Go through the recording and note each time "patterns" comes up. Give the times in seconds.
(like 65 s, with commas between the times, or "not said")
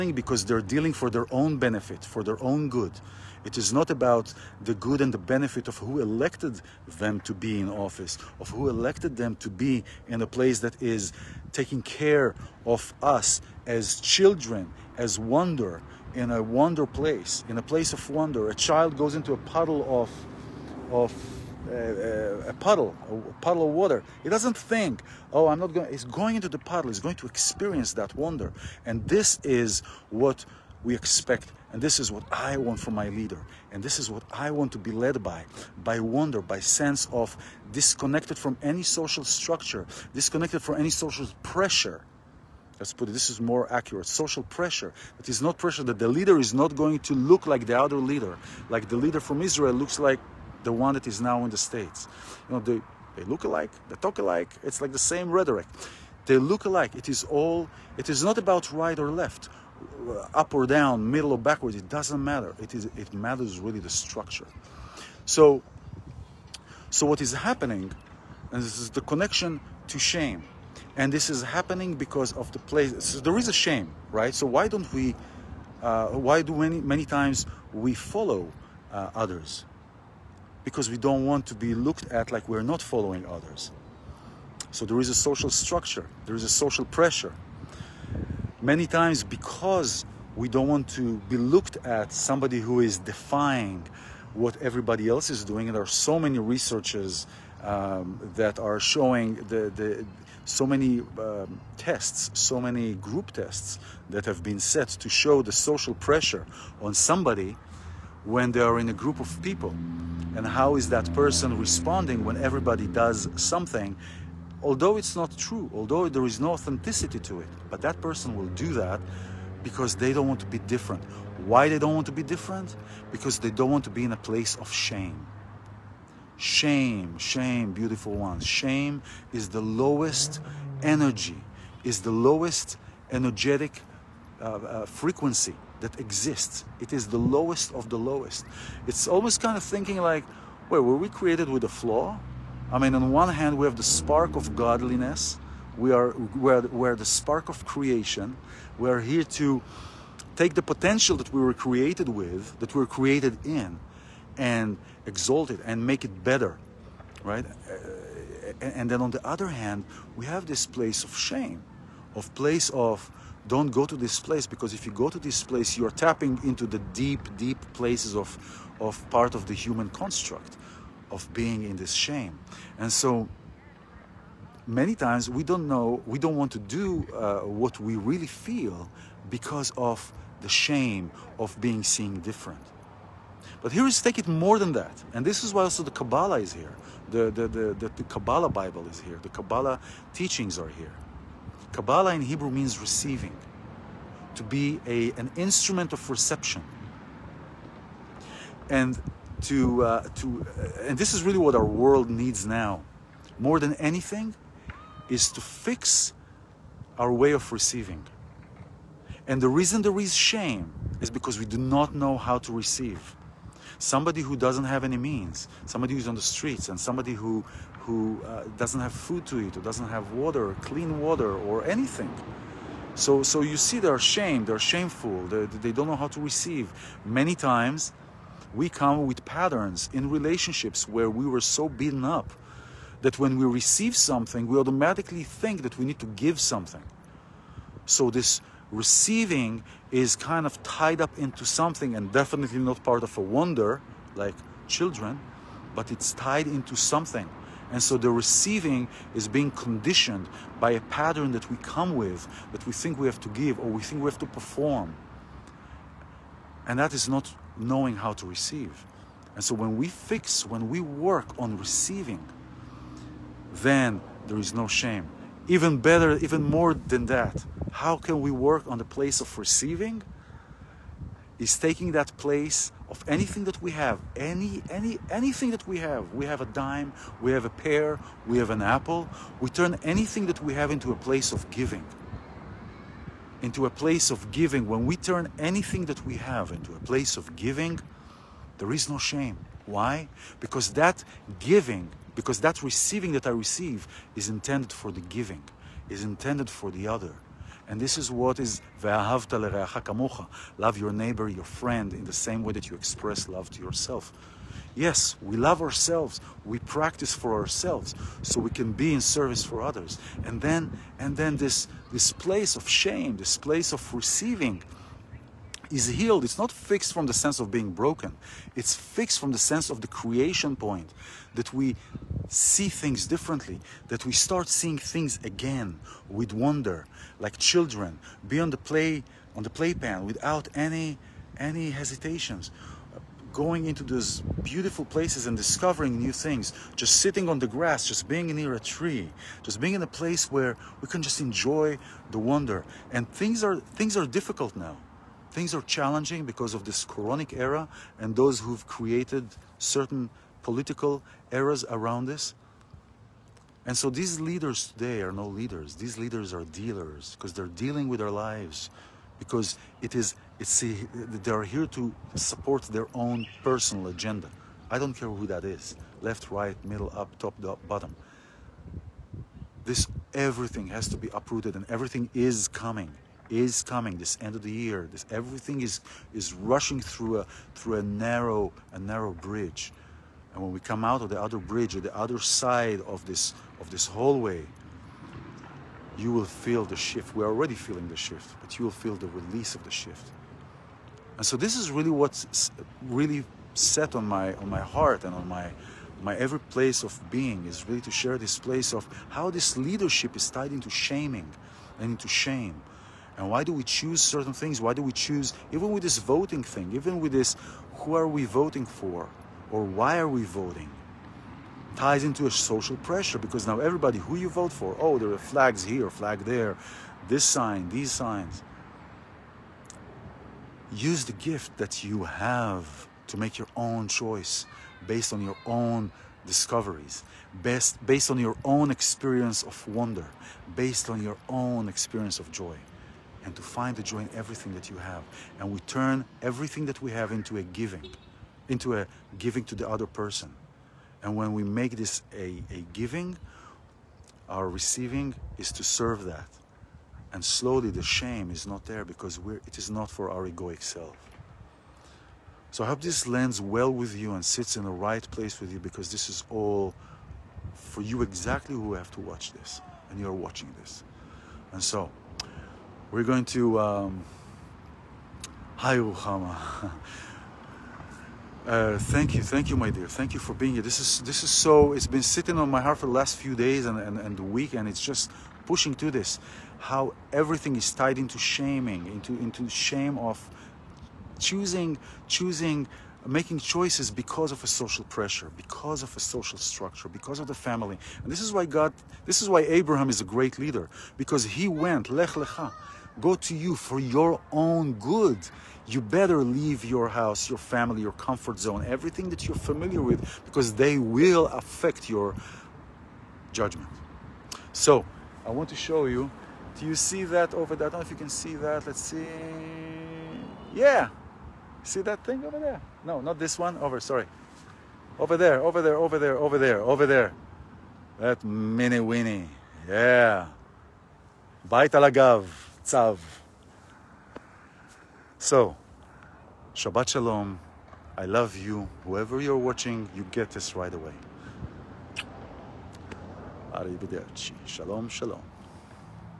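229 s, 250 s.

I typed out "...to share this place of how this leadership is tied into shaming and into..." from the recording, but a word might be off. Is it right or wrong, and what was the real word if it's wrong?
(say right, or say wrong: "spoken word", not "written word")
right.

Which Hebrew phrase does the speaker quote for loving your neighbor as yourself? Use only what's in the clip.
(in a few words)
Ve'ahavta le'reacha kamocha.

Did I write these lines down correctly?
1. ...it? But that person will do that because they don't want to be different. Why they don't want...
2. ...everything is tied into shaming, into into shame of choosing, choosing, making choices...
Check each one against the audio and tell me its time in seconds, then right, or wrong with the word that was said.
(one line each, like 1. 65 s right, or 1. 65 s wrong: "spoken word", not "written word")
1. 117 s right
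2. 477 s right.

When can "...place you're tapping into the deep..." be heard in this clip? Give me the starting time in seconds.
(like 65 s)
165 s.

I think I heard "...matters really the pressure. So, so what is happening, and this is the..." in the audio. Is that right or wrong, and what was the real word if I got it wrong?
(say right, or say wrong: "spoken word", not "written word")
wrong: "structure", not "pressure".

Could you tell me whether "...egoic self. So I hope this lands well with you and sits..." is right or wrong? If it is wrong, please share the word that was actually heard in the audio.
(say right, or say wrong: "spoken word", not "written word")
right.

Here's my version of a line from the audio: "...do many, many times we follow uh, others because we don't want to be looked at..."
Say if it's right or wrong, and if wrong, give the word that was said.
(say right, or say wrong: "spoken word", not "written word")
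right.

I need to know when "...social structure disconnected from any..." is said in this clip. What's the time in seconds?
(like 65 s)
38 s.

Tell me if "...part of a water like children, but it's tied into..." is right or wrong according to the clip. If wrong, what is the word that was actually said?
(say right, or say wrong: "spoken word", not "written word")
wrong: "wonder", not "water".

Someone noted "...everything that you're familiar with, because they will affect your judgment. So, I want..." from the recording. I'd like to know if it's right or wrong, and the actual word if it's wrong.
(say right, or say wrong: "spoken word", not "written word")
right.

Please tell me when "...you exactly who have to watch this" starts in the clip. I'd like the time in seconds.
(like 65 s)
457 s.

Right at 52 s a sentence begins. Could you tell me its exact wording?
You know, they, they look alike, they talk alike, it's like the same rhetoric.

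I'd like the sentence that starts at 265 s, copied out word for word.
Even better, even more than that, how can we work on the place of receiving?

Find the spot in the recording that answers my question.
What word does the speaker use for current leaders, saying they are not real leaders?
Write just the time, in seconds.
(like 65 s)
355 s.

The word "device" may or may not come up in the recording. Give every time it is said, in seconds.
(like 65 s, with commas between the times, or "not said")
not said.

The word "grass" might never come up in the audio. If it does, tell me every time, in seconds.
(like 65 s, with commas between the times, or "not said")
337 s.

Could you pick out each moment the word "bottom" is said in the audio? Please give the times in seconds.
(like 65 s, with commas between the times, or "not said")
367 s.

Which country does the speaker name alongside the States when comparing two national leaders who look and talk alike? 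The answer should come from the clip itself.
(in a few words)
Israel.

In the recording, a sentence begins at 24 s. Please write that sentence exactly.
He doesn't think, oh, I'm not going, he's going into the puddle, he's going to experience that wonder.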